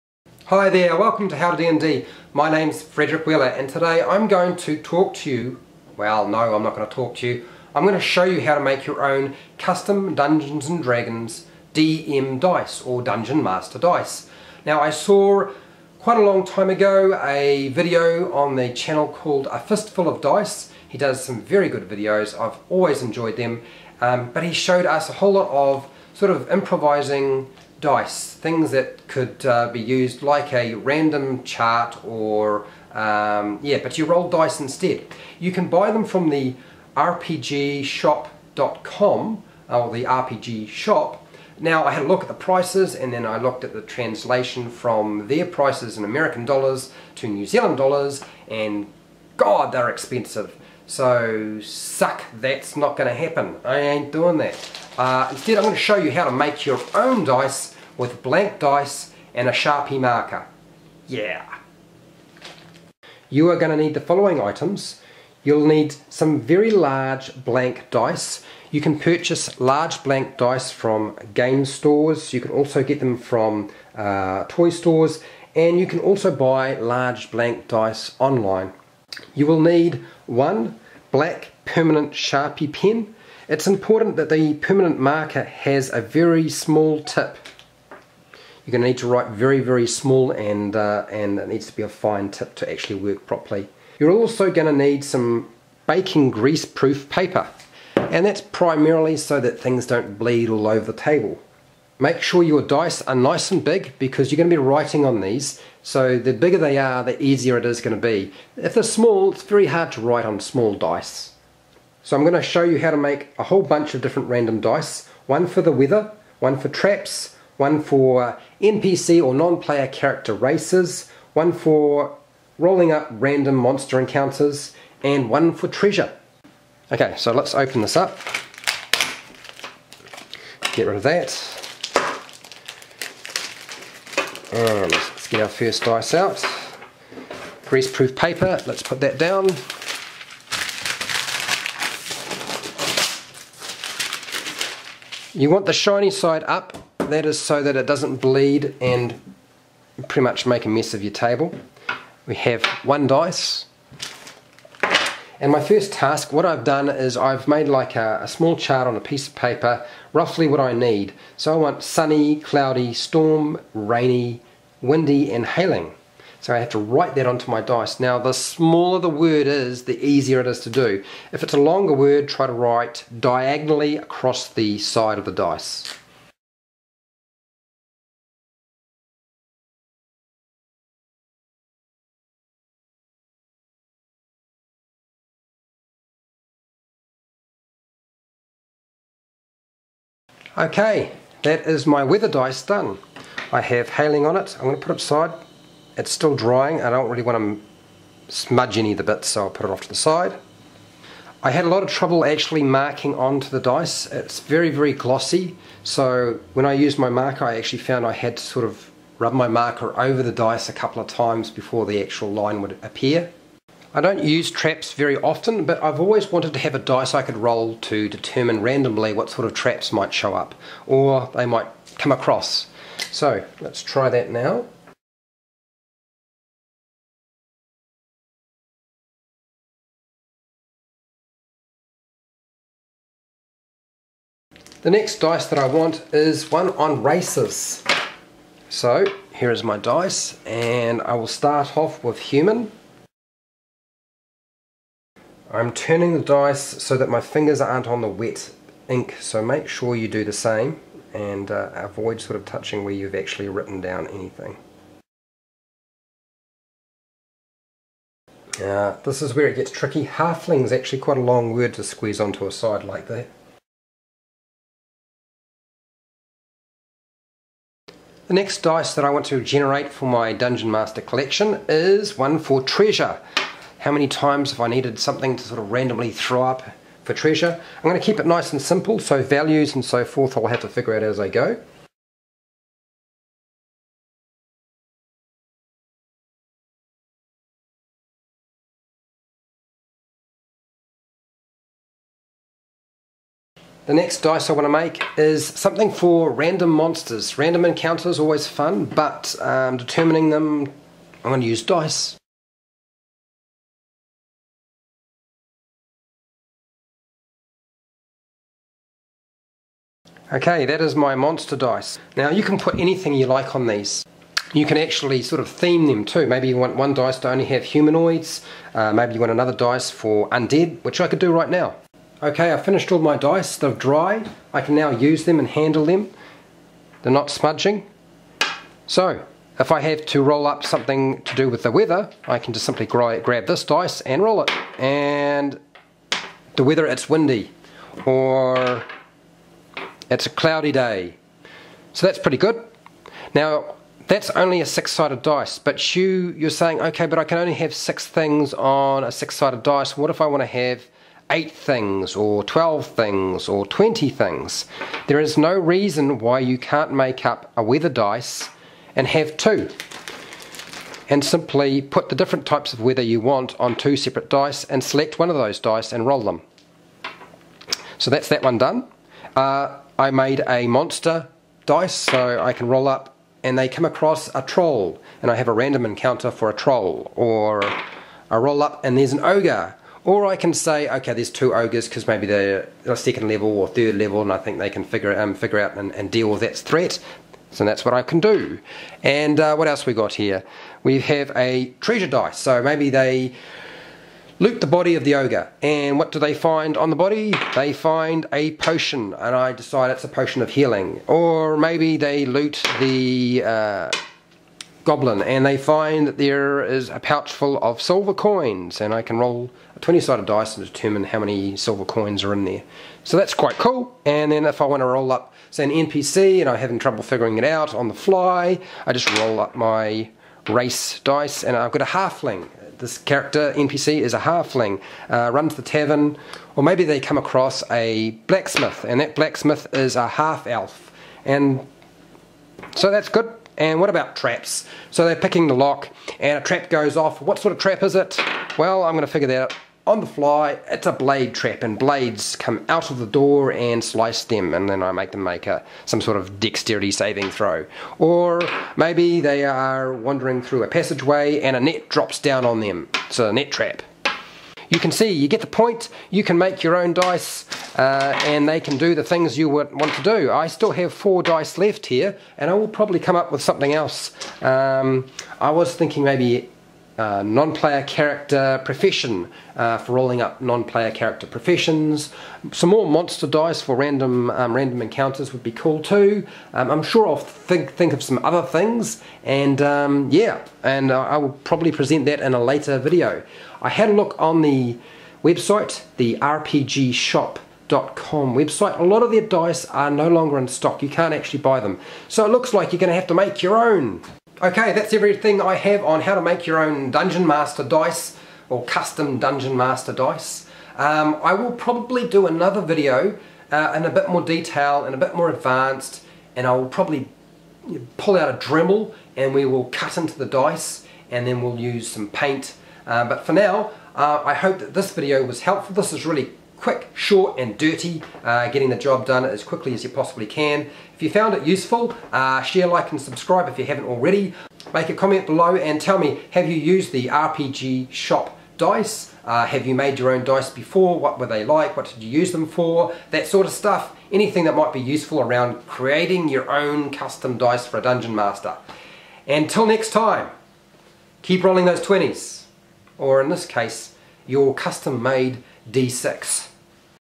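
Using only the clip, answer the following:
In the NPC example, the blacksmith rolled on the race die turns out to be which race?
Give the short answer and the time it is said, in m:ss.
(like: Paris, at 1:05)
half elf, at 7:10.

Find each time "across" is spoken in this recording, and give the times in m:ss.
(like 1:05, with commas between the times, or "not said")
2:53, 3:42, 6:13, 7:07.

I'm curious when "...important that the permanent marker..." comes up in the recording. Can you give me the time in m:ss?
1:23.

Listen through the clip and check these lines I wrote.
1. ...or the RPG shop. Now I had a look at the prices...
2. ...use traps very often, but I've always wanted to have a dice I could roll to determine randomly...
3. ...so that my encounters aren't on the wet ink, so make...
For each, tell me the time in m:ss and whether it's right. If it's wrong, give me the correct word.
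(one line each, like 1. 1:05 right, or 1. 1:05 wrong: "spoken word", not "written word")
1. 0:39 right
2. 3:34 right
3. 4:06 wrong: "fingers", not "encounters".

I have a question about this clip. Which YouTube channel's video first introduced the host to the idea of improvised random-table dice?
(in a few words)
A Fistful of Dice.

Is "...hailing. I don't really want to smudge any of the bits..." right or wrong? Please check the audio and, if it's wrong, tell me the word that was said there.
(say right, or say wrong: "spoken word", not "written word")
wrong: "drying", not "hailing".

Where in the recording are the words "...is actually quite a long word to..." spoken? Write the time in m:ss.
4:20.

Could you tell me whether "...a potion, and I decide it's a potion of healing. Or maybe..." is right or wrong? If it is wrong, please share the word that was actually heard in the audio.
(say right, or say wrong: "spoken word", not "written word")
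right.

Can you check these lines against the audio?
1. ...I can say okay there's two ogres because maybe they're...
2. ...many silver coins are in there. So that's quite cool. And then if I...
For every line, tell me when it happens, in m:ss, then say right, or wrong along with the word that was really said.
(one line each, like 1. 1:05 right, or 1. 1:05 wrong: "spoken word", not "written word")
1. 6:20 right
2. 6:51 right.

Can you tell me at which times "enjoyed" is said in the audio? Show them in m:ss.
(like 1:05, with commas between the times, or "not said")
0:23.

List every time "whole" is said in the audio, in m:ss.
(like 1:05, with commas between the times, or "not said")
0:25, 1:53.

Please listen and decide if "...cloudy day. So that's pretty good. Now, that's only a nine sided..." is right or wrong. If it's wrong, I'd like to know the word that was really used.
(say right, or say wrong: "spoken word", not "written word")
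wrong: "six", not "nine".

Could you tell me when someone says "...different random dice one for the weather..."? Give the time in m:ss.
1:54.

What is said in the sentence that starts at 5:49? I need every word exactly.
What if I want to have eight things, or 12 things, or 20 things?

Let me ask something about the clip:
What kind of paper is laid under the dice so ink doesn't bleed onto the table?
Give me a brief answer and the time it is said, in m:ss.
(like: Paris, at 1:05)
greaseproof paper, at 1:36.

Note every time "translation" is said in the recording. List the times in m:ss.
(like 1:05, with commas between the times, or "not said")
0:43.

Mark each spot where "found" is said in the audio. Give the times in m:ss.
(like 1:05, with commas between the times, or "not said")
3:27, 8:41.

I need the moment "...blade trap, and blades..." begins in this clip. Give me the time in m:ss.
7:20.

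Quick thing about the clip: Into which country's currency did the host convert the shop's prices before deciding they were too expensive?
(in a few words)
New Zealand dollars.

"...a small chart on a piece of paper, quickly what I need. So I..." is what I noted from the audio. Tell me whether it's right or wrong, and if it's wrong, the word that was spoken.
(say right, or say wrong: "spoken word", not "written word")
wrong: "roughly", not "quickly".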